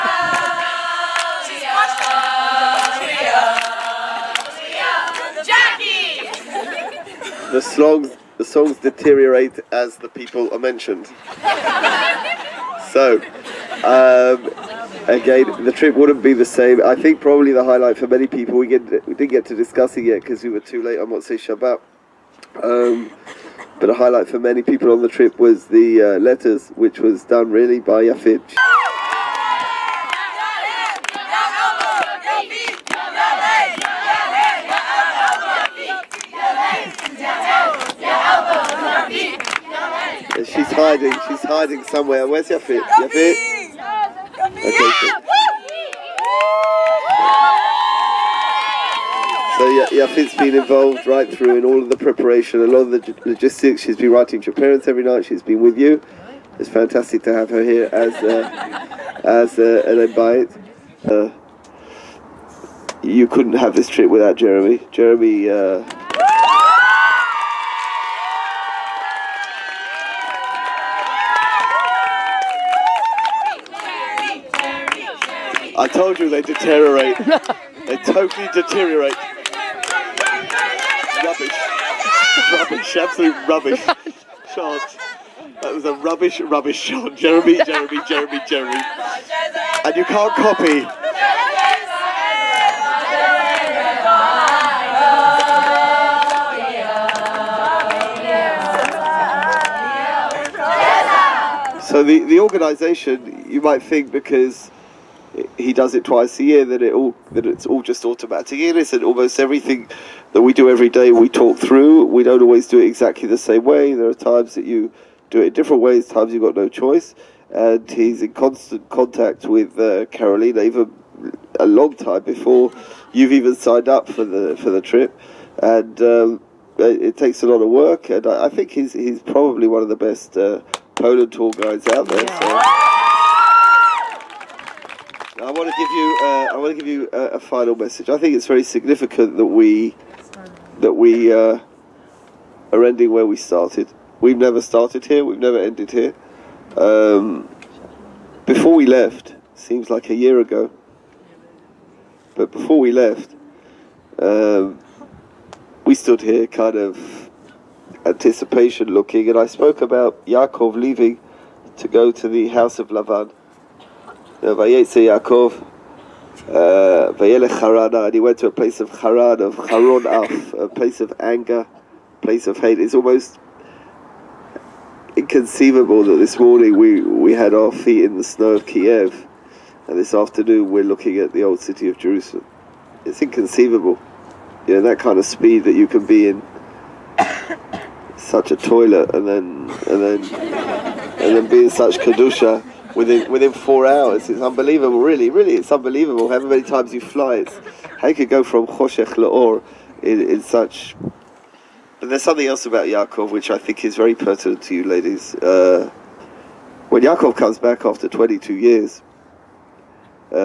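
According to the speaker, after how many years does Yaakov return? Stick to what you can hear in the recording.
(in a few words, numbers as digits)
22.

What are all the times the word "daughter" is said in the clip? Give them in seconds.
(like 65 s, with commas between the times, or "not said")
not said.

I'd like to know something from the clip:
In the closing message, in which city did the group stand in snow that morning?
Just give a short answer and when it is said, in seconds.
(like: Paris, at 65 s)
Kiev, at 178 s.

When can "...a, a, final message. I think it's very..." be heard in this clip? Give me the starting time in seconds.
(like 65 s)
137 s.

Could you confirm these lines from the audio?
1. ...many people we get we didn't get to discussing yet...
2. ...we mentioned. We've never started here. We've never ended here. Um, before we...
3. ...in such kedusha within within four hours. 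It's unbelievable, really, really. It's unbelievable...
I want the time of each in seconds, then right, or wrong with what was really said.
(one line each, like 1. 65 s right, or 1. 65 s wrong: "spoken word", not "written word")
1. 18 s right
2. 143 s wrong: "started", not "mentioned"
3. 191 s right.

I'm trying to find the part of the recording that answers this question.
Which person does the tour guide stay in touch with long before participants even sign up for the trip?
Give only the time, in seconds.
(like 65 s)
120 s.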